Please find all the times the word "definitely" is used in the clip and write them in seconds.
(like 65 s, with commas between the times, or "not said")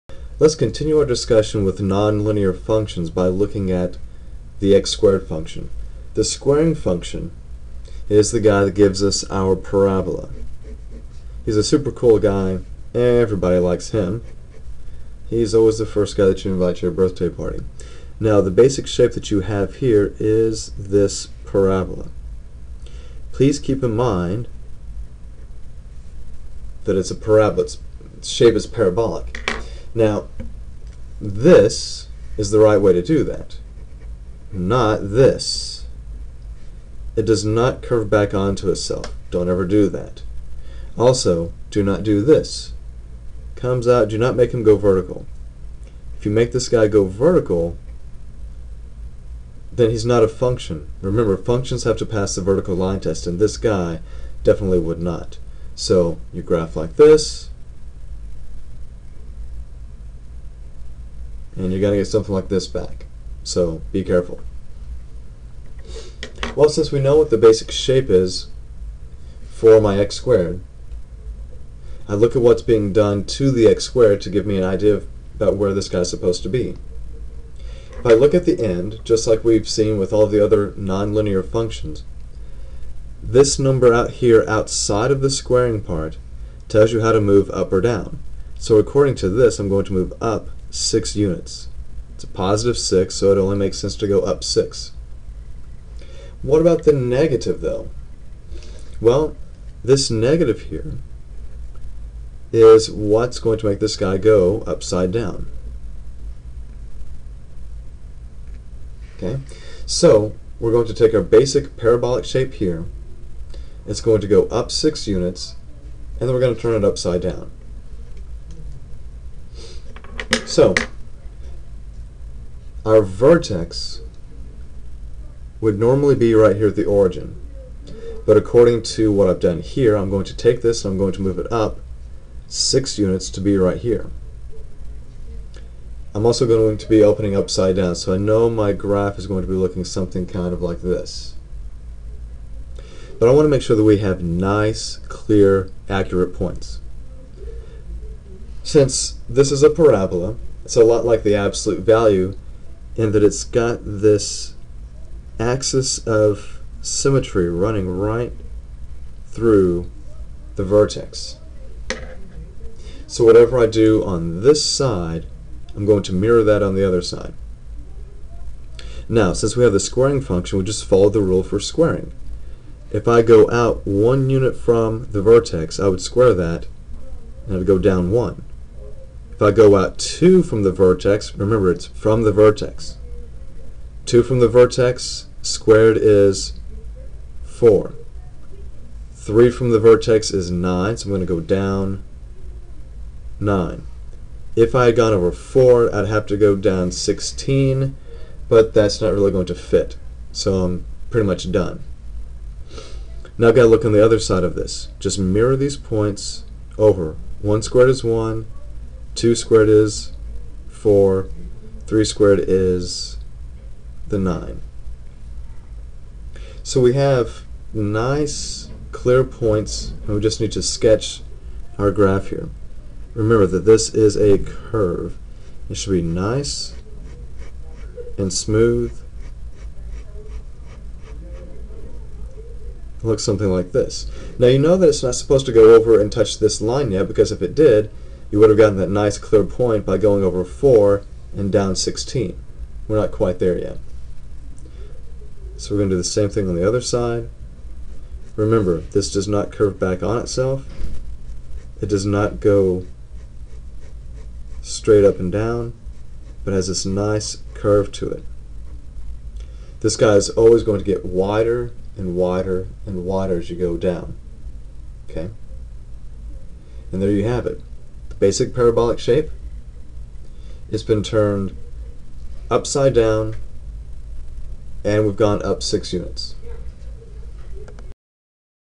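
54 s.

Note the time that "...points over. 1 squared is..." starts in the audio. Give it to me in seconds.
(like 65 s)
205 s.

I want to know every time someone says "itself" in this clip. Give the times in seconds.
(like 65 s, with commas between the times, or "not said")
38 s, 250 s.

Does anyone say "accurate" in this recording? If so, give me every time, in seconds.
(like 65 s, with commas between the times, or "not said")
145 s.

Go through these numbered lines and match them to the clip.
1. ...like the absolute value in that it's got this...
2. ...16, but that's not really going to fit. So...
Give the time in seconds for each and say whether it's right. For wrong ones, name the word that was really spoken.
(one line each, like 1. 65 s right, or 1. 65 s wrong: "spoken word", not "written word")
1. 151 s right
2. 196 s right.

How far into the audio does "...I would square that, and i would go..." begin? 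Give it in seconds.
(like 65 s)
175 s.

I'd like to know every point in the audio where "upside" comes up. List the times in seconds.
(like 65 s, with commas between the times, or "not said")
104 s, 116 s, 137 s, 272 s.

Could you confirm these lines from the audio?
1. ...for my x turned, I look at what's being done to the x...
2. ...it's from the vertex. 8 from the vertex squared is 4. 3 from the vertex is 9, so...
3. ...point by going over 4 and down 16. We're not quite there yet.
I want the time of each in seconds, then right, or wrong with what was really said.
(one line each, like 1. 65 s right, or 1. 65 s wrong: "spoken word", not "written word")
1. 69 s wrong: "squared", not "turned"
2. 181 s wrong: "2", not "8"
3. 239 s right.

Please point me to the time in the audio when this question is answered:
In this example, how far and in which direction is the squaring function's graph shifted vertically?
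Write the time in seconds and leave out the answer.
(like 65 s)
89 s.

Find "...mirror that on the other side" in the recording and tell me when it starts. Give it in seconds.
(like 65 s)
166 s.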